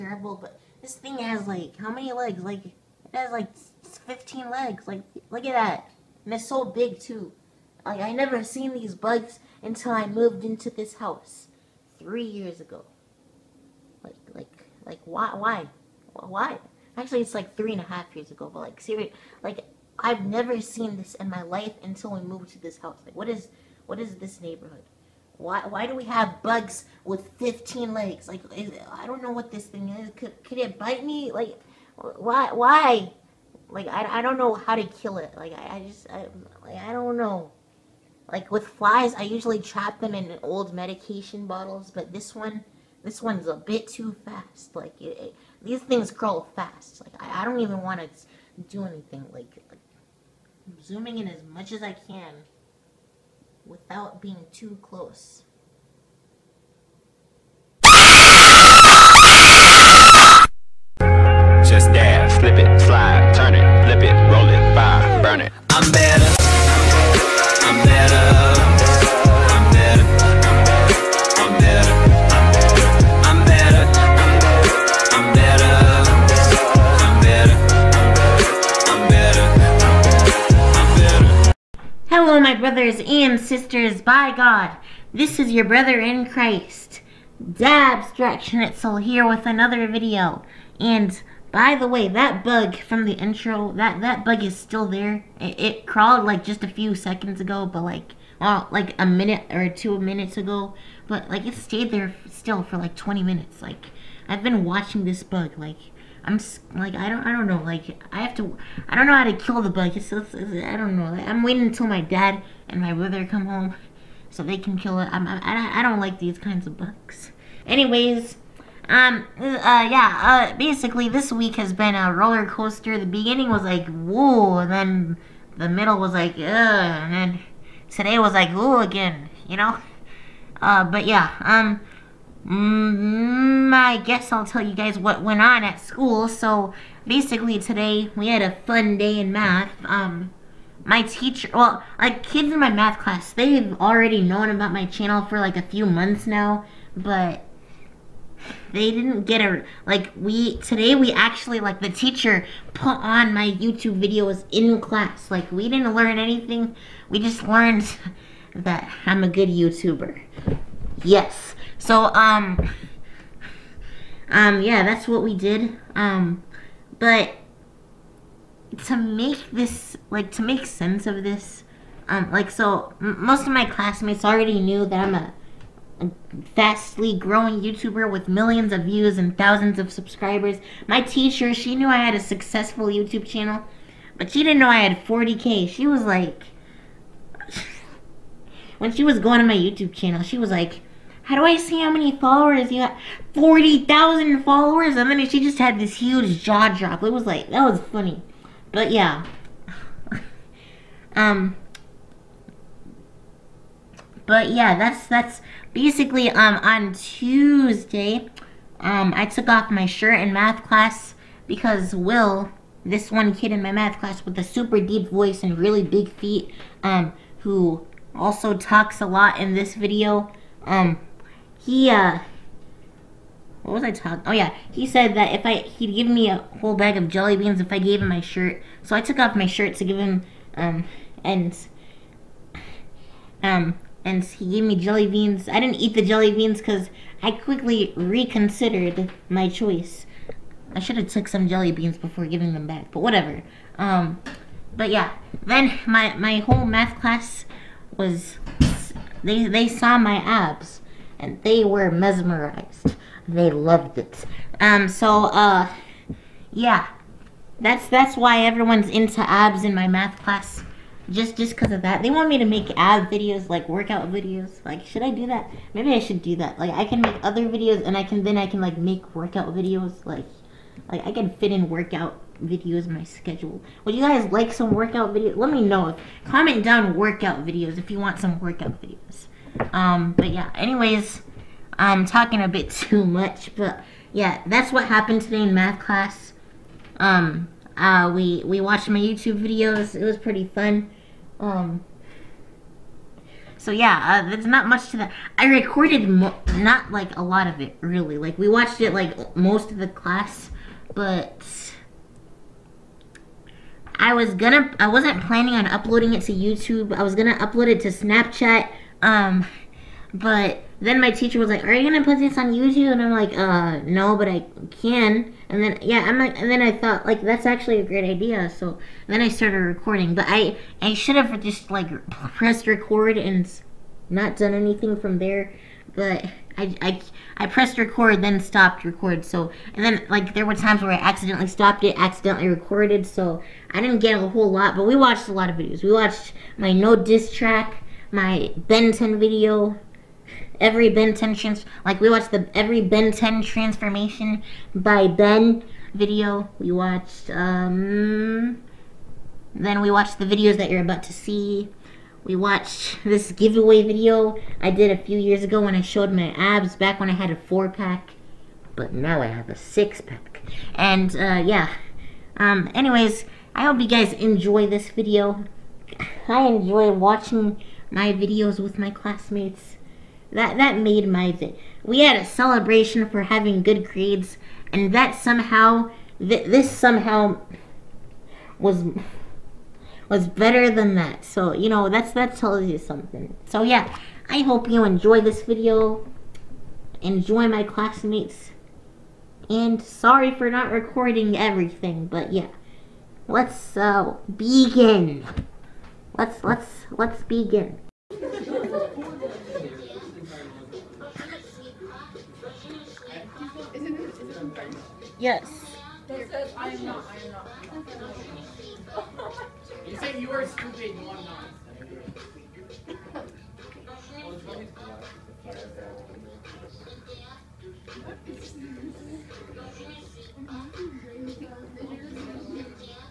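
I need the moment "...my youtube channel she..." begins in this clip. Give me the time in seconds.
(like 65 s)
189 s.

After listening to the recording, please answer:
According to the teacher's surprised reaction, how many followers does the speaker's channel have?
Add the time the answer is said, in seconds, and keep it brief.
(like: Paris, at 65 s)
40,000, at 193 s.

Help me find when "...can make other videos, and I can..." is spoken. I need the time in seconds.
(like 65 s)
266 s.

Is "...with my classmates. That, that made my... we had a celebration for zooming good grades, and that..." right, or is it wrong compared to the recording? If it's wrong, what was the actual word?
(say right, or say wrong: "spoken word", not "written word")
wrong: "having", not "zooming".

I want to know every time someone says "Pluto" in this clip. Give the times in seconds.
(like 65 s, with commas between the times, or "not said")
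not said.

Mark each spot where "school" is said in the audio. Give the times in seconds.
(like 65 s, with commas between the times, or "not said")
135 s.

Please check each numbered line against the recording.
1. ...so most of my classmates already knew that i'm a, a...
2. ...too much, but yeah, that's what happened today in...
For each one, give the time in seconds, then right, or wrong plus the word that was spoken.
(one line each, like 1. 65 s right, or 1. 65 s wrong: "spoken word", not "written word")
1. 172 s right
2. 282 s right.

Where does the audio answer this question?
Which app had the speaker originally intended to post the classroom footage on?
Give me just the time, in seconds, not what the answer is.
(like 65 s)
307 s.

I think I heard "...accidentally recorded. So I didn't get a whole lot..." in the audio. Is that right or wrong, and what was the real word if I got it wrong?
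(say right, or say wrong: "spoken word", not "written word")
right.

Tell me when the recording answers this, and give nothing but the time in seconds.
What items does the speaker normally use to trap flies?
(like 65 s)
40 s.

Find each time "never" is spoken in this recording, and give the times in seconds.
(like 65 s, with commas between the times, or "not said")
8 s, 20 s.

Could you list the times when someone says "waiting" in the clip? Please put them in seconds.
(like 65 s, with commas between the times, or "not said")
111 s.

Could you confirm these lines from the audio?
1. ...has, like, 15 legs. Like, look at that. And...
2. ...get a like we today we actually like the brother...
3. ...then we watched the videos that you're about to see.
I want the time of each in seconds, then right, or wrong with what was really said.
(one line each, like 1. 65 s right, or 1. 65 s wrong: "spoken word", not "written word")
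1. 3 s right
2. 149 s wrong: "teacher", not "brother"
3. 349 s right.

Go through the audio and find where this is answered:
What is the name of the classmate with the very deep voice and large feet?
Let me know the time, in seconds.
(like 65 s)
211 s.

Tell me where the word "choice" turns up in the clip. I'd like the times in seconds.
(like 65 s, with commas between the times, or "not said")
239 s.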